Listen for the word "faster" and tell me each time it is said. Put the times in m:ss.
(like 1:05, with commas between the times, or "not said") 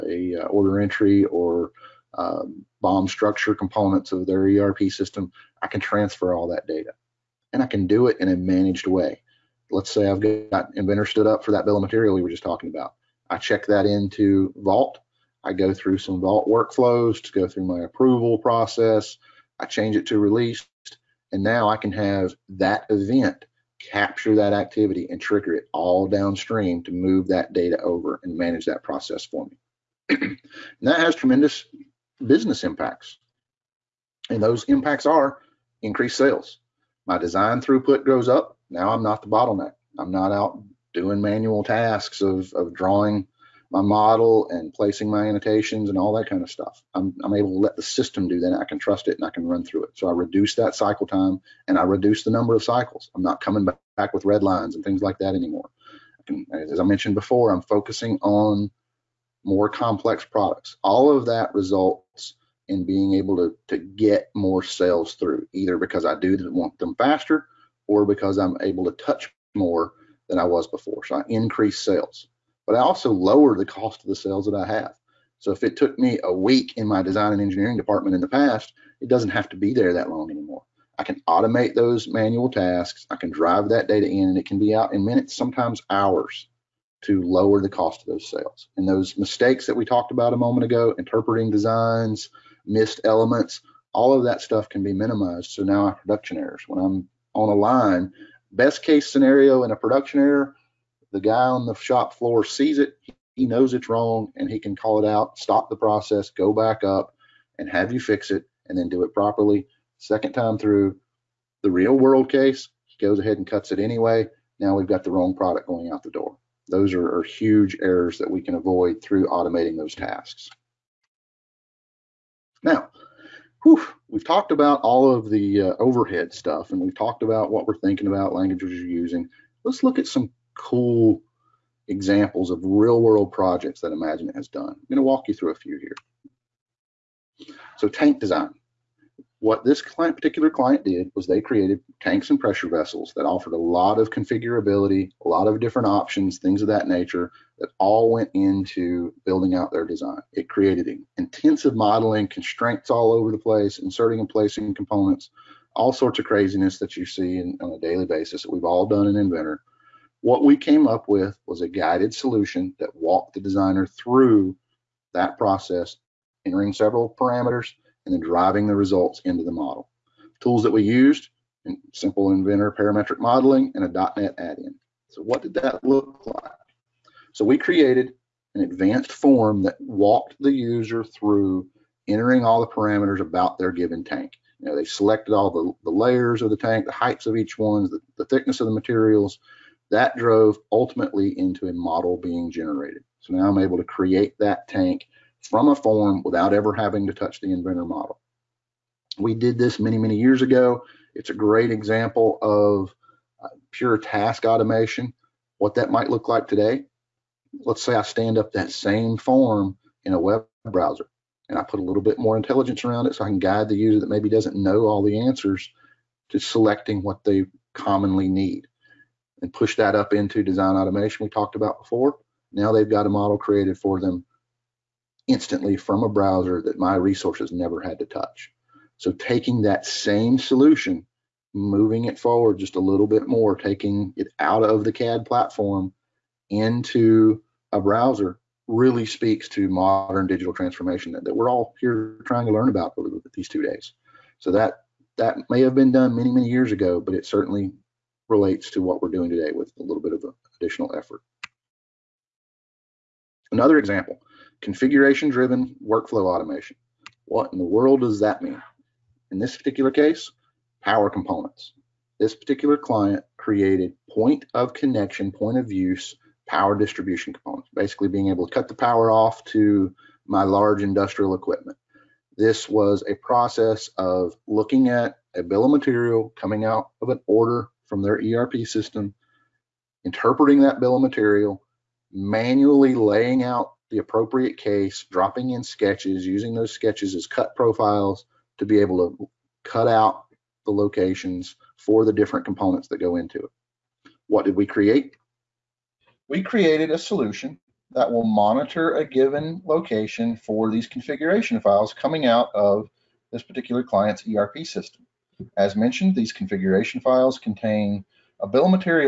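1:06.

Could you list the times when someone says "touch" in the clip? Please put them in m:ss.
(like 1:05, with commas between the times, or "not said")
1:08, 3:17, 3:48.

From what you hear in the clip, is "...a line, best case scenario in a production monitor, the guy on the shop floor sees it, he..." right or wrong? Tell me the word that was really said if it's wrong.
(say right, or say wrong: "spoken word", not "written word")
wrong: "error", not "monitor".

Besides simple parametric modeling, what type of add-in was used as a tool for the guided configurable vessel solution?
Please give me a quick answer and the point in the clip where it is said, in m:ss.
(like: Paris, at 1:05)
.NET add-in, at 2:54.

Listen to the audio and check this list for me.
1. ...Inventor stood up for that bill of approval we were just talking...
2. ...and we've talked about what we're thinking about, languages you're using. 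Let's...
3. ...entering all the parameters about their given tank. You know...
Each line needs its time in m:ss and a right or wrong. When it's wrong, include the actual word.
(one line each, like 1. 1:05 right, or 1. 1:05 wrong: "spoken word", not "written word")
1. 0:10 wrong: "material", not "approval"
2. 2:06 right
3. 3:02 right.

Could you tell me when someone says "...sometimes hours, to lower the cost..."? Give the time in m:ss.
1:25.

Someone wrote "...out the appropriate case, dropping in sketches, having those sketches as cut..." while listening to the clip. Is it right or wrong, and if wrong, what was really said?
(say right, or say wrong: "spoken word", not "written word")
wrong: "using", not "having".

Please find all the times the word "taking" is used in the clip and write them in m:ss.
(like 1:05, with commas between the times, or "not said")
3:49, 3:53.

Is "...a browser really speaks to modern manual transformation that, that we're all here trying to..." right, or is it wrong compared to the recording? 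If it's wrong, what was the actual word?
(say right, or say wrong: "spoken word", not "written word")
wrong: "digital", not "manual".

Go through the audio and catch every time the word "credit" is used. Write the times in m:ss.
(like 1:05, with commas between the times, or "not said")
not said.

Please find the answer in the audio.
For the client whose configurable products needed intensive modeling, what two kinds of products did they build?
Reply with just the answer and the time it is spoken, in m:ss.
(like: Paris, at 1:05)
Tanks and pressure vessels, at 2:22.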